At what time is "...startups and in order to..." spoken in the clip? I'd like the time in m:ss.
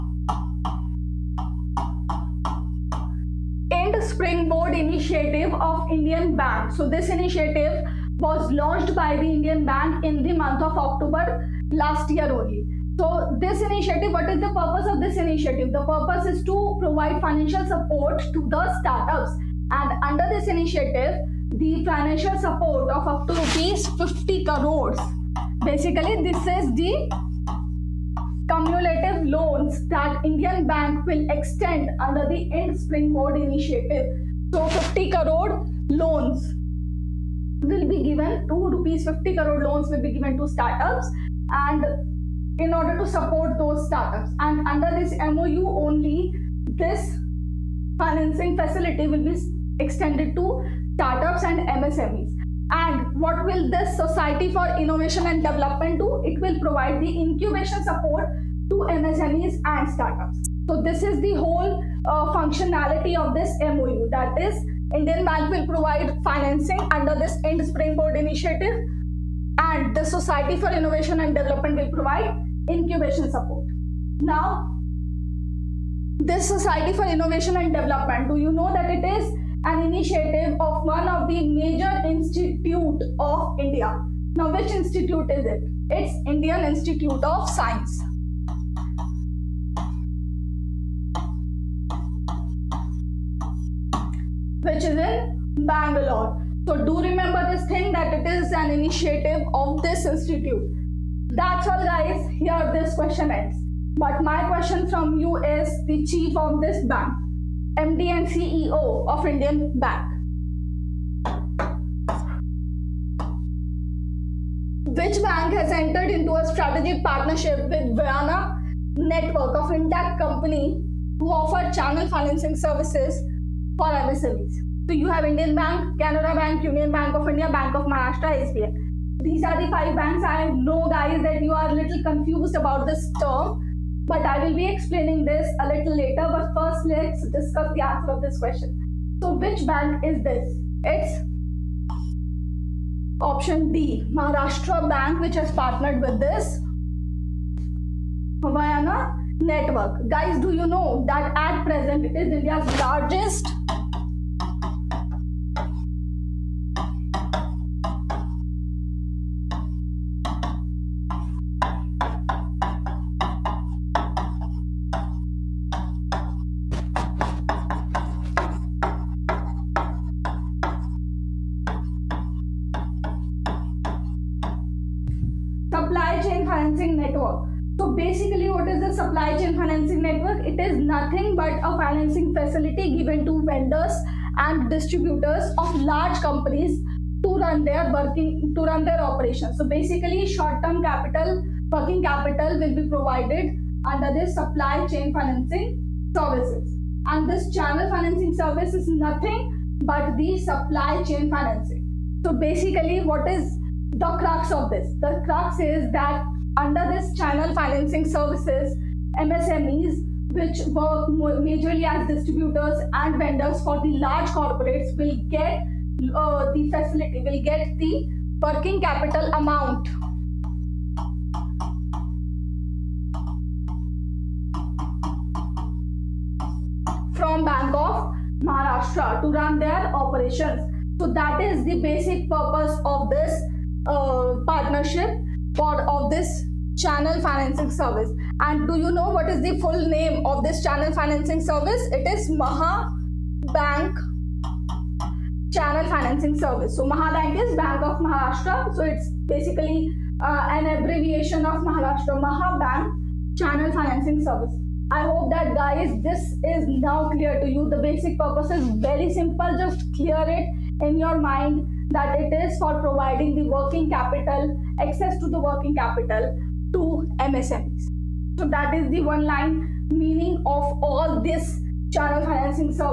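0:40.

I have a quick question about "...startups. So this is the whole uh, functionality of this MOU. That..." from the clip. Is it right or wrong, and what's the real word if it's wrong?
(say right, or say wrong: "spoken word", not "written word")
right.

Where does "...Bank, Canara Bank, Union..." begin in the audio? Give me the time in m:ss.
2:05.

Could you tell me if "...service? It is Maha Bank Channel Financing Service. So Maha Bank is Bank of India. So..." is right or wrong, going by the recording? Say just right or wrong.
wrong.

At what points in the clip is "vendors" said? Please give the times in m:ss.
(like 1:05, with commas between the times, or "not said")
3:03, 3:33.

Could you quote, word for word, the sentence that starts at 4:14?
I hope that guys, this is now clear to you.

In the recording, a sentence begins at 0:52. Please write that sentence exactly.
And what will this Society for Innovation and Development do?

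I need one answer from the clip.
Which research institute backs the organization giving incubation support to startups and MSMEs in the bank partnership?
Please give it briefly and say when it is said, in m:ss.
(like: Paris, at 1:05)
Indian Institute of Science, at 1:26.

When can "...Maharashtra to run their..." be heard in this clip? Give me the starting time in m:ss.
3:48.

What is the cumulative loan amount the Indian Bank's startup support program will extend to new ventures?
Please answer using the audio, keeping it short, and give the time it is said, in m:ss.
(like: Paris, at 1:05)
50 crore rupees, at 0:23.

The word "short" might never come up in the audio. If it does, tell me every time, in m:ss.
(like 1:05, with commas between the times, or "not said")
3:10.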